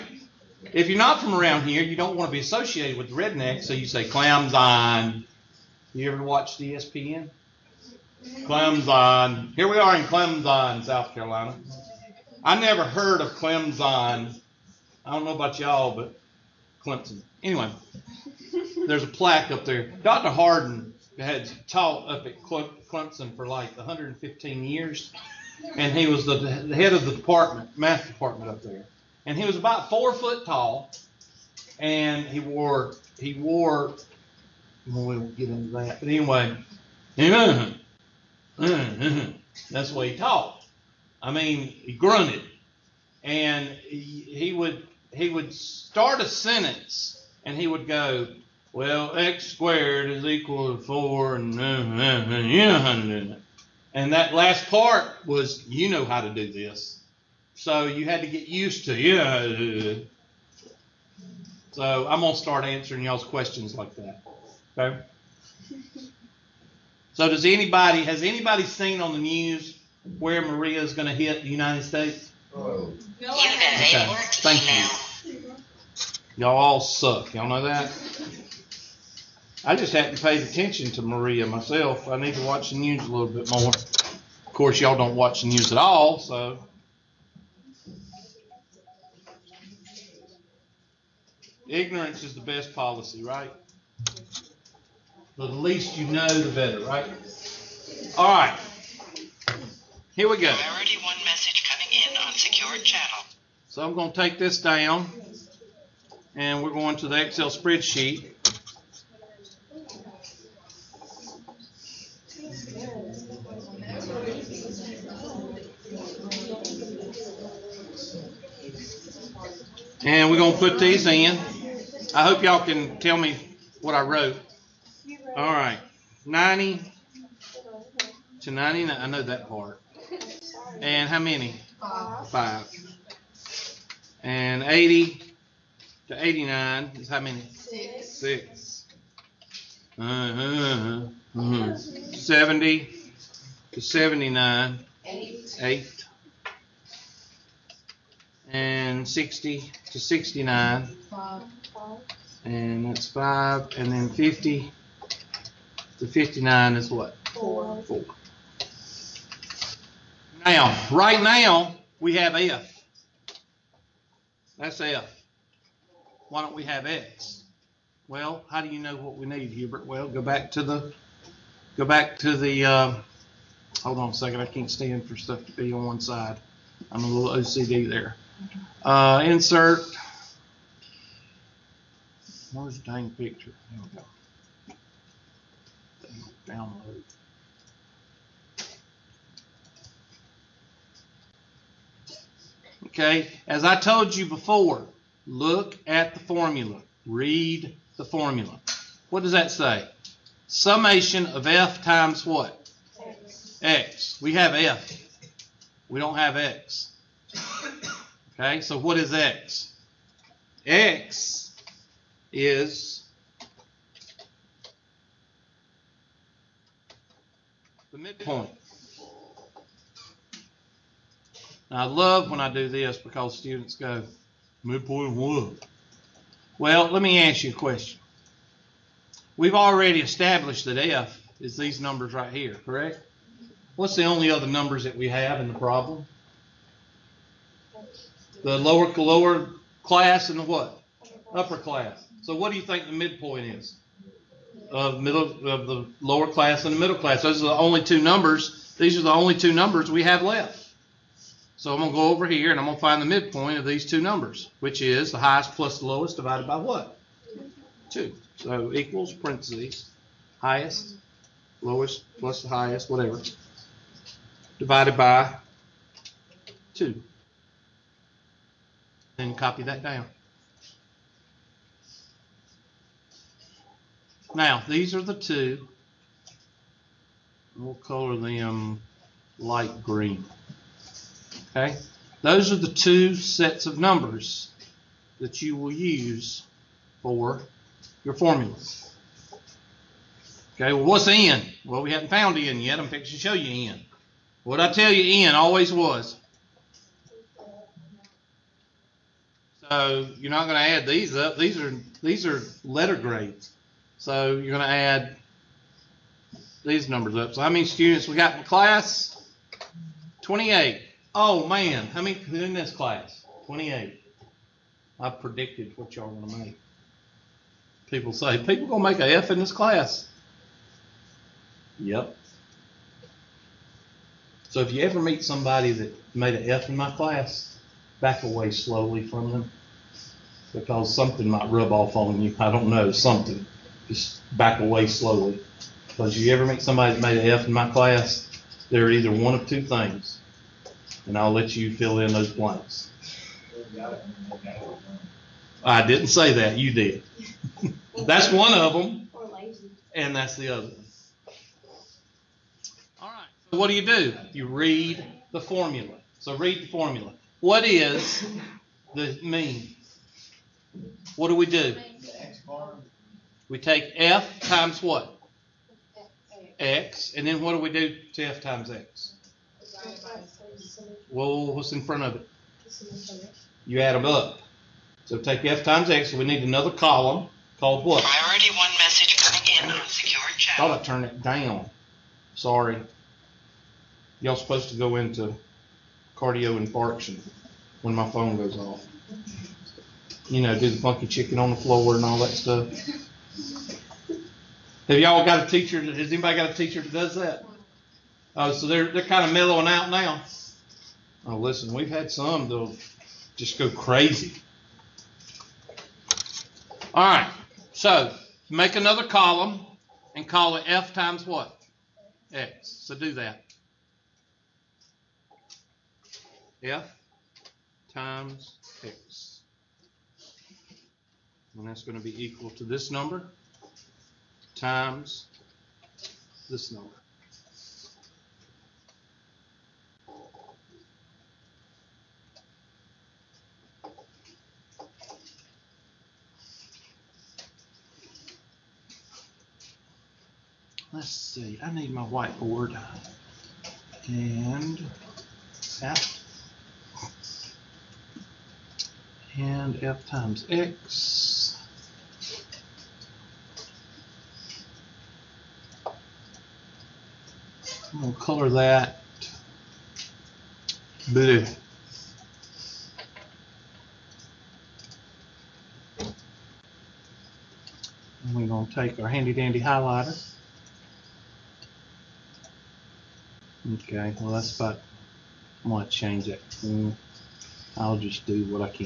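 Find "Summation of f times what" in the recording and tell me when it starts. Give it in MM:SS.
03:20.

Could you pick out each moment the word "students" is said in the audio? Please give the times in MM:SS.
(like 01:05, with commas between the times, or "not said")
03:43, 05:07.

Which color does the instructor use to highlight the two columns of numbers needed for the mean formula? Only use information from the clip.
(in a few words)
light green.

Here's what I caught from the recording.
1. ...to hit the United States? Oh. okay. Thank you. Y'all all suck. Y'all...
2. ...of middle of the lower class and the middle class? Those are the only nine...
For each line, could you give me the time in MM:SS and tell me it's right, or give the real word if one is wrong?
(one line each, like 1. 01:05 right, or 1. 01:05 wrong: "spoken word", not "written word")
1. 01:11 right
2. 04:04 wrong: "two", not "nine".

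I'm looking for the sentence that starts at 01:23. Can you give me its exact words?
Of course, y'all don't watch the news at all, so.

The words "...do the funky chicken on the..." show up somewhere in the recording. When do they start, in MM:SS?
06:30.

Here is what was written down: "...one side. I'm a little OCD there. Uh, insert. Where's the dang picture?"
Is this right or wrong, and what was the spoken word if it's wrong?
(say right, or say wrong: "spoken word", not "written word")
right.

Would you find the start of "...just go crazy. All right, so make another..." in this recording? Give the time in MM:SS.
06:43.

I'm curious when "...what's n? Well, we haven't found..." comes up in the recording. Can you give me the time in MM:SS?
04:50.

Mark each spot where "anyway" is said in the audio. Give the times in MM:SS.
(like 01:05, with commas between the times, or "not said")
00:17, 00:36.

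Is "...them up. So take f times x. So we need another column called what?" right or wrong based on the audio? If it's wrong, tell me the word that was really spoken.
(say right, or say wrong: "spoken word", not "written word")
right.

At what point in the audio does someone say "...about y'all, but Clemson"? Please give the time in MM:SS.
00:15.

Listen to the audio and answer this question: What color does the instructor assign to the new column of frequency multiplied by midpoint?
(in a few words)
blue.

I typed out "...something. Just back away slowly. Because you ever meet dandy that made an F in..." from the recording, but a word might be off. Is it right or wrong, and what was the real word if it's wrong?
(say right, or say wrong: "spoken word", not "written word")
wrong: "somebody", not "dandy".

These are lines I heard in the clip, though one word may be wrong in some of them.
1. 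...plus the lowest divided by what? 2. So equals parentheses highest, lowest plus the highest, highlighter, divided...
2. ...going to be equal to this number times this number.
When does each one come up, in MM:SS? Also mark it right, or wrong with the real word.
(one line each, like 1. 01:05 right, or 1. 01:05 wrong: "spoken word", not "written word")
1. 04:15 wrong: "whatever", not "highlighter"
2. 07:01 right.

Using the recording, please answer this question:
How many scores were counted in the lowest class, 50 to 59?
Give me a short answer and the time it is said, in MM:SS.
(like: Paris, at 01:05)
4, at 02:37.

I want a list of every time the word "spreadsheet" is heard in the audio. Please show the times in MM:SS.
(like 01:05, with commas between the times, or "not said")
01:47.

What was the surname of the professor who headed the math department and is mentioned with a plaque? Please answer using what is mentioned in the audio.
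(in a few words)
Harden.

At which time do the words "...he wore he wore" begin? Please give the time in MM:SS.
00:32.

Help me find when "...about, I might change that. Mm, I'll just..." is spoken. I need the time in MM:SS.
07:54.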